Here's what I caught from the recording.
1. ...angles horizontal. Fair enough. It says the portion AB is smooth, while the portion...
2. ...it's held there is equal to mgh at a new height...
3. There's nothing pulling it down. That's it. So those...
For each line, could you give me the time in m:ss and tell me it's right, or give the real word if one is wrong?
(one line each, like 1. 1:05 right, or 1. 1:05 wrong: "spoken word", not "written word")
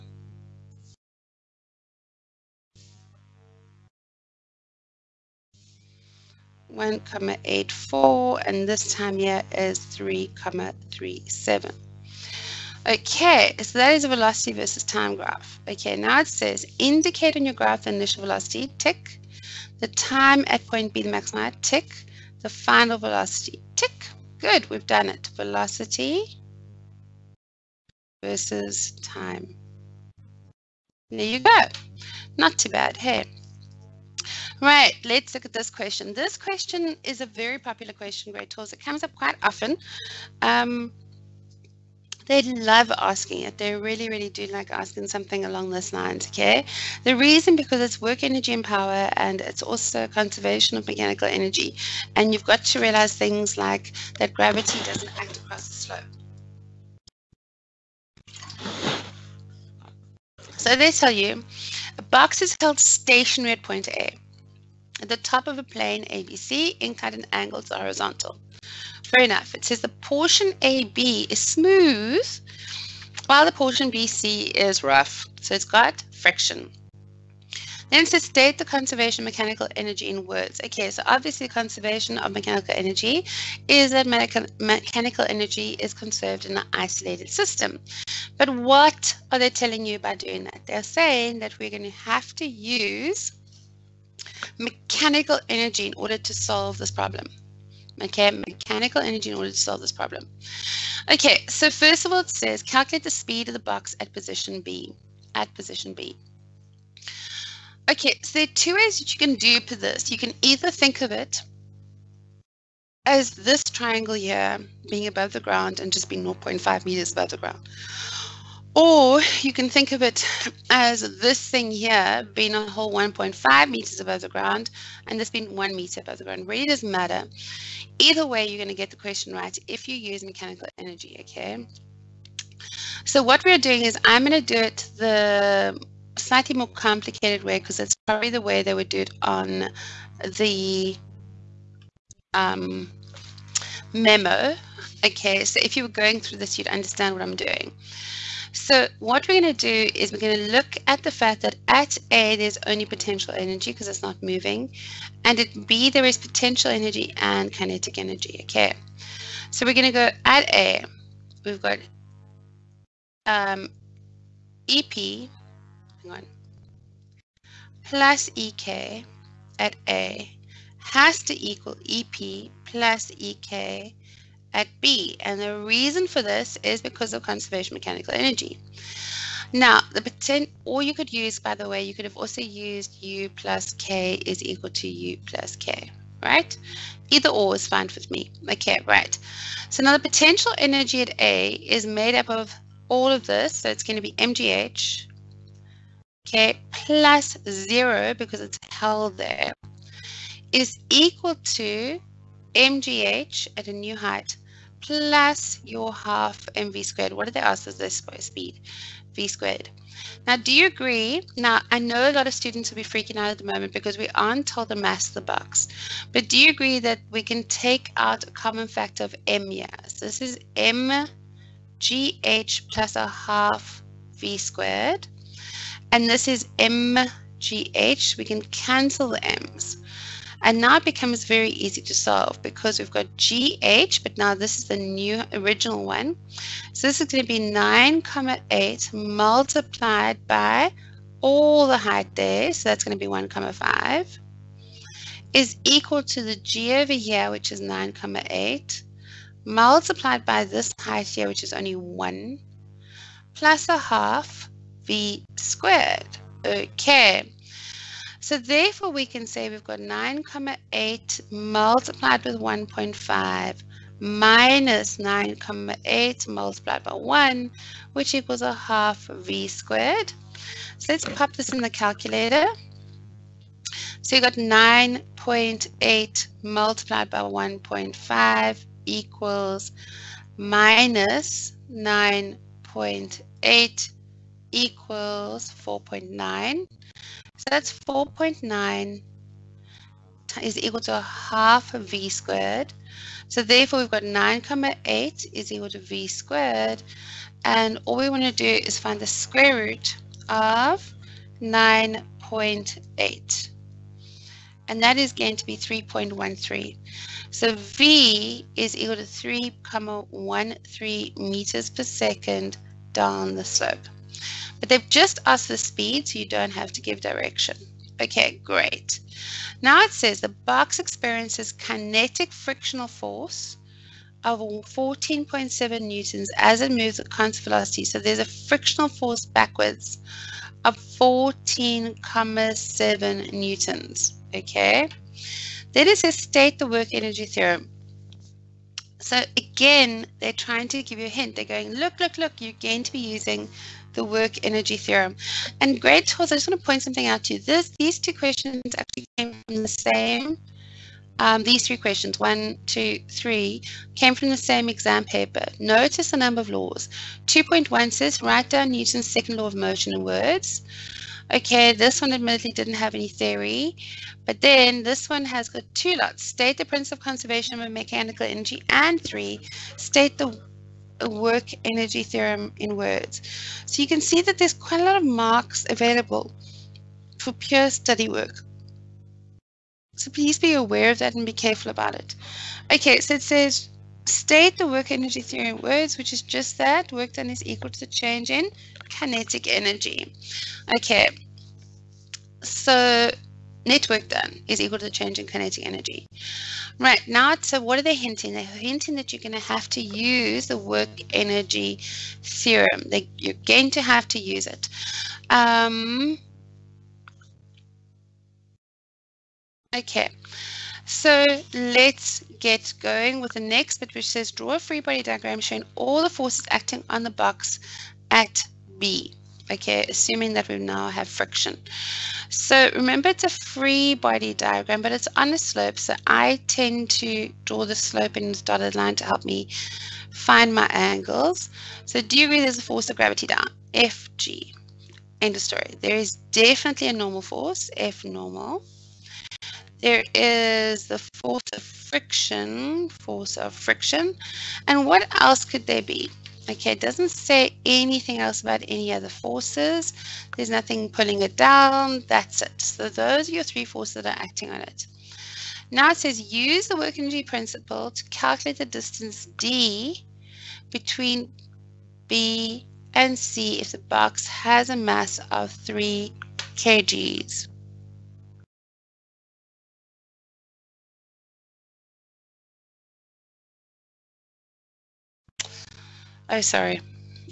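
1. 1:07 right
2. 3:18 right
3. 7:30 right.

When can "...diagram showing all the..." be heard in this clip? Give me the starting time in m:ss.
6:55.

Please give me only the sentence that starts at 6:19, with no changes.
So please be aware of that and be careful about it.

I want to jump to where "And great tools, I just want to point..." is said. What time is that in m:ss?
5:45.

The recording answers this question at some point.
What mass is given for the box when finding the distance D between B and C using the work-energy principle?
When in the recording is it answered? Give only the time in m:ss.
7:45.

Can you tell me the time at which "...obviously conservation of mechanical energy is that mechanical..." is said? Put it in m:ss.
1:21.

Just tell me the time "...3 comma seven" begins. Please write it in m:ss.
0:09.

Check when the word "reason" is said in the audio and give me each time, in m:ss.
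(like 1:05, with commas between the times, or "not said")
0:47, 2:55.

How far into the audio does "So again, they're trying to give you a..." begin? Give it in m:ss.
5:38.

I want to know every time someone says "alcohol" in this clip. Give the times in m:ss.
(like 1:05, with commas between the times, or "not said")
not said.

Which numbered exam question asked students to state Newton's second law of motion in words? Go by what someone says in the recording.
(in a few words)
2.1.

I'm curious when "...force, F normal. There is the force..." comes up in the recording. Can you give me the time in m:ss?
7:17.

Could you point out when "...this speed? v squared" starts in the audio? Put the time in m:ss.
3:27.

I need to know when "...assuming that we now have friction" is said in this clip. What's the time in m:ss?
6:59.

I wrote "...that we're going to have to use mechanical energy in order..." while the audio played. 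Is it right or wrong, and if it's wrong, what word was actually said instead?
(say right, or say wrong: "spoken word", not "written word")
right.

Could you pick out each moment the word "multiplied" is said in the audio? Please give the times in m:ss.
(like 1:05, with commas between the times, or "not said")
3:58, 4:09, 4:21, 4:26, 4:36.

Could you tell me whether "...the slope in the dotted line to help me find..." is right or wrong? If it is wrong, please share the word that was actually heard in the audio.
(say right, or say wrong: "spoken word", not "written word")
right.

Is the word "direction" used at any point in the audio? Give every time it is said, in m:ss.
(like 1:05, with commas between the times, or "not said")
5:17.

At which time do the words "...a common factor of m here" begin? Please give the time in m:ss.
3:38.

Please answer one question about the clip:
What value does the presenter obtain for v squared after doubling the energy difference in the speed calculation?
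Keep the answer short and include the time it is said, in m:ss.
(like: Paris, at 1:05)
9.8, at 4:54.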